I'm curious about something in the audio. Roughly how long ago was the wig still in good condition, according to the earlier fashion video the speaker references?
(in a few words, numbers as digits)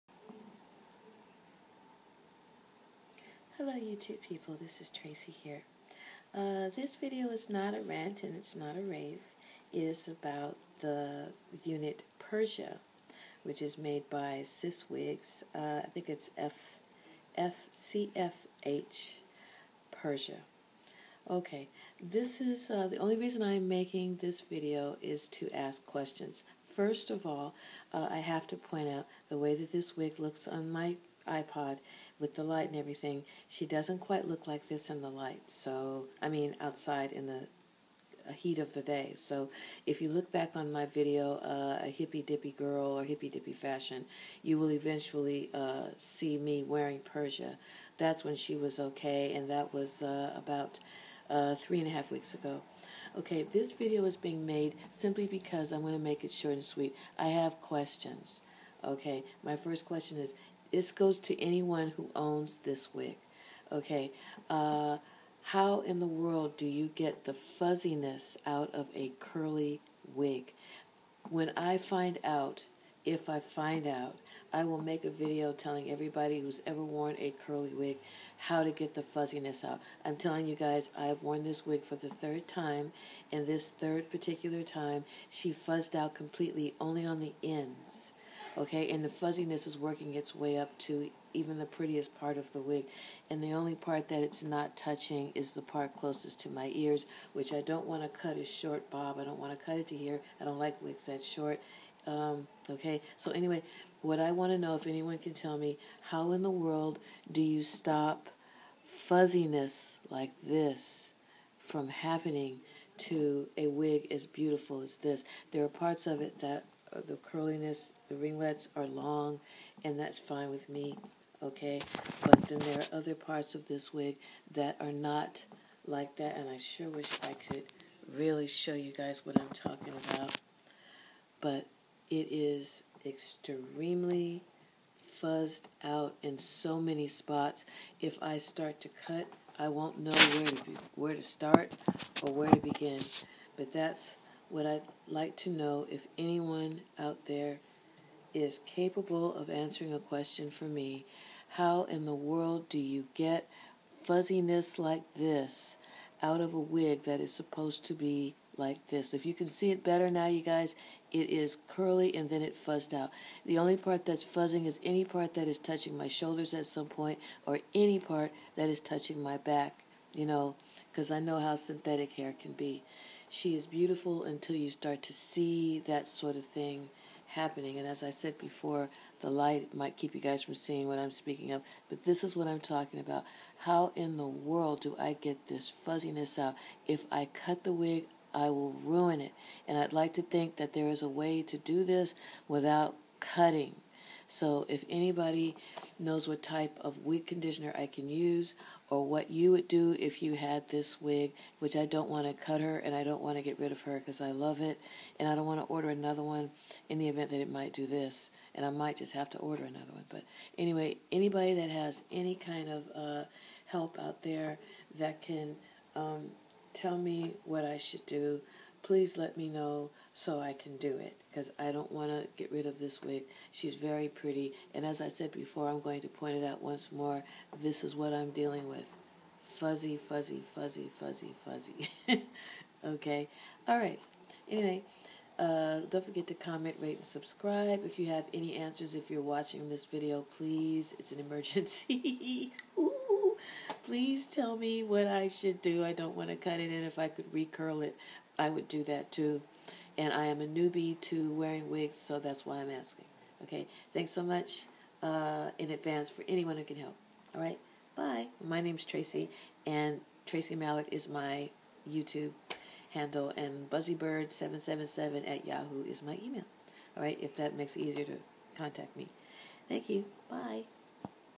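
3 and a half weeks.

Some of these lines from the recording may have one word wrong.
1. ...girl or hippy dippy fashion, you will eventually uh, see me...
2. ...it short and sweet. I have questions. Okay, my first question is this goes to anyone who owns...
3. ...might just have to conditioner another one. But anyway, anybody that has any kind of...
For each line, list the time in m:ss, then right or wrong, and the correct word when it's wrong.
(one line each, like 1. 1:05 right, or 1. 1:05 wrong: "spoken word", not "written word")
1. 0:42 right
2. 0:56 right
3. 3:28 wrong: "order", not "conditioner".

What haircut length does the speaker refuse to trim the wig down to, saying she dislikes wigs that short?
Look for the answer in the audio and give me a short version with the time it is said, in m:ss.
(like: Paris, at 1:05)
short bob, at 1:38.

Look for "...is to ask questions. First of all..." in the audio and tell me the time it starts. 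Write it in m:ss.
0:25.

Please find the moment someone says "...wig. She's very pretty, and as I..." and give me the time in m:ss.
3:43.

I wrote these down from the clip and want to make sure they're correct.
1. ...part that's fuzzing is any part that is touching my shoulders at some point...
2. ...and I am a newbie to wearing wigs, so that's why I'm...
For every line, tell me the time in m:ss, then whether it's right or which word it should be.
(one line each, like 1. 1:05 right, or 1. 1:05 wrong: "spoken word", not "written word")
1. 2:43 right
2. 4:10 right.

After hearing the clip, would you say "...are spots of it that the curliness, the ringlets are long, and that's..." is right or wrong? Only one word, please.
wrong.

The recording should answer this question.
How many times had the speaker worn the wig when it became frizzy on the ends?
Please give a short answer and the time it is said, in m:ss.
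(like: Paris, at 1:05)
3, at 1:21.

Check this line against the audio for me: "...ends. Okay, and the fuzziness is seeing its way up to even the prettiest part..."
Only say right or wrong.
wrong.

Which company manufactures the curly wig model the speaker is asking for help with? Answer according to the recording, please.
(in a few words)
SiS Wigs.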